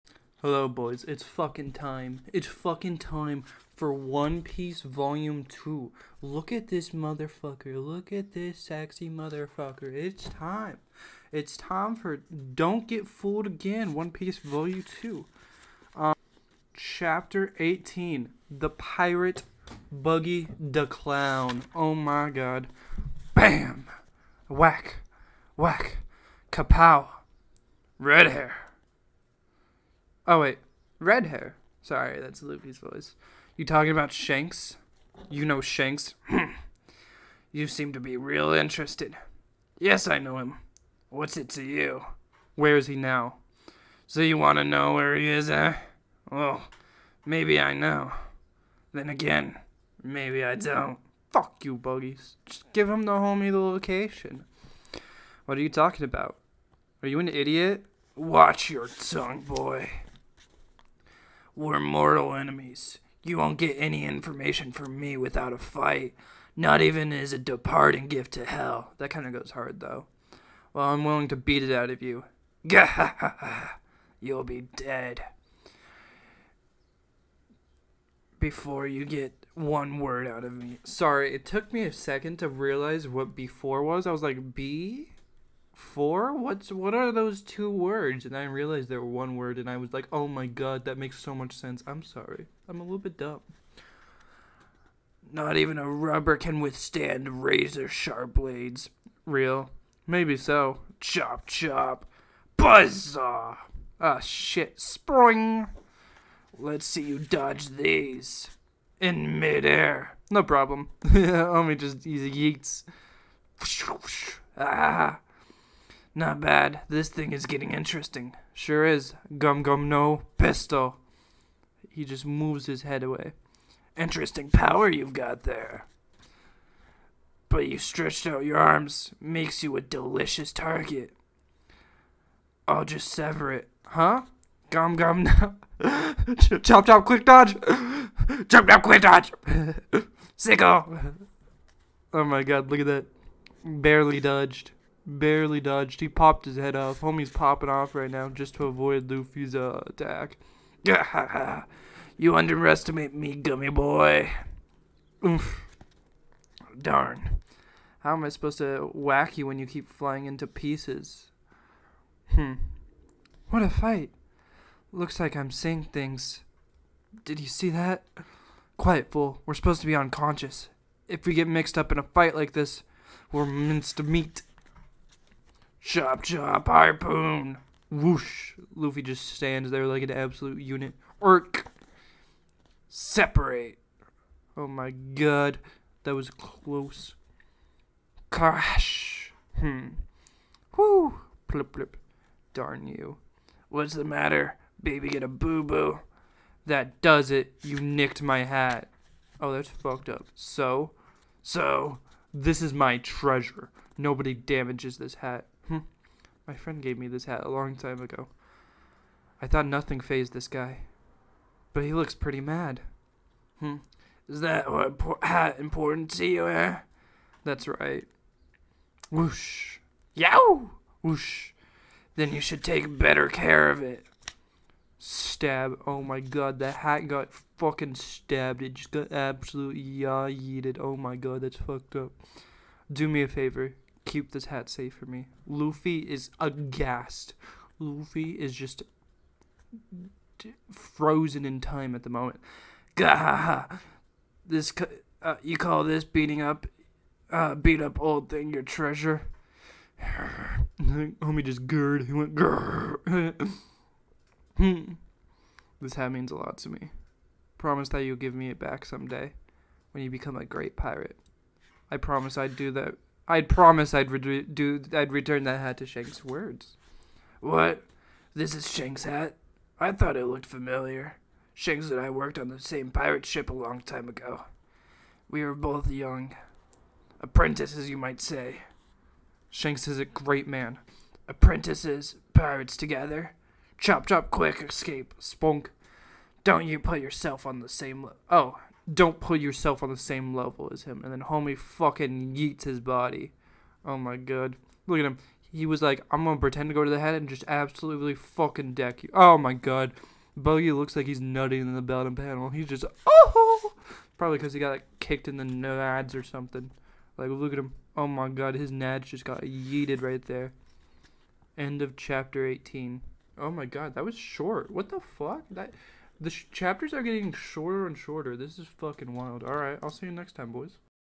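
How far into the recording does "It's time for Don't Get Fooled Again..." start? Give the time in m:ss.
0:11.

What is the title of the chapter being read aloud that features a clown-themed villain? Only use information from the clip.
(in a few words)
The Pirate Buggy the Clown.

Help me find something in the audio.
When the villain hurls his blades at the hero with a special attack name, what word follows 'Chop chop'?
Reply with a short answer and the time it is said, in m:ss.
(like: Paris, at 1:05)
Buzzsaw, at 1:42.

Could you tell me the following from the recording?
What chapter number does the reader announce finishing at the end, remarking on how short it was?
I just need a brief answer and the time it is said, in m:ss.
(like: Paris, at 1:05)
18, at 5:11.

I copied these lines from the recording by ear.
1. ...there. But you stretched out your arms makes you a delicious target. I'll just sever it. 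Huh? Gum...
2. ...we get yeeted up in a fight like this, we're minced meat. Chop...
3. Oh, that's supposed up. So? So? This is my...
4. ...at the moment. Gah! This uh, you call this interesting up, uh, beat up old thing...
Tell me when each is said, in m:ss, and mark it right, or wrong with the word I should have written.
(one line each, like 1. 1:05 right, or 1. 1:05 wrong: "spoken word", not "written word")
1. 2:05 right
2. 2:51 wrong: "mixed", not "yeeted"
3. 3:19 wrong: "fucked", not "supposed"
4. 4:01 wrong: "beating", not "interesting".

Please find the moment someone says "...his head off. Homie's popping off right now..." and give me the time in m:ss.
2:26.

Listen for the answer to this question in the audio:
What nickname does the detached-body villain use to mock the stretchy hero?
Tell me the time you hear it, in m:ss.
2:33.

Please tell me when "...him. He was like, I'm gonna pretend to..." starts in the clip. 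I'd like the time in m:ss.
4:55.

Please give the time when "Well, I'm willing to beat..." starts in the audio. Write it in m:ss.
1:10.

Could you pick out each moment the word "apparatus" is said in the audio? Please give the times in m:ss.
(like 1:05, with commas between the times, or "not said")
not said.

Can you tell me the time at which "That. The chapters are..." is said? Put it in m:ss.
5:15.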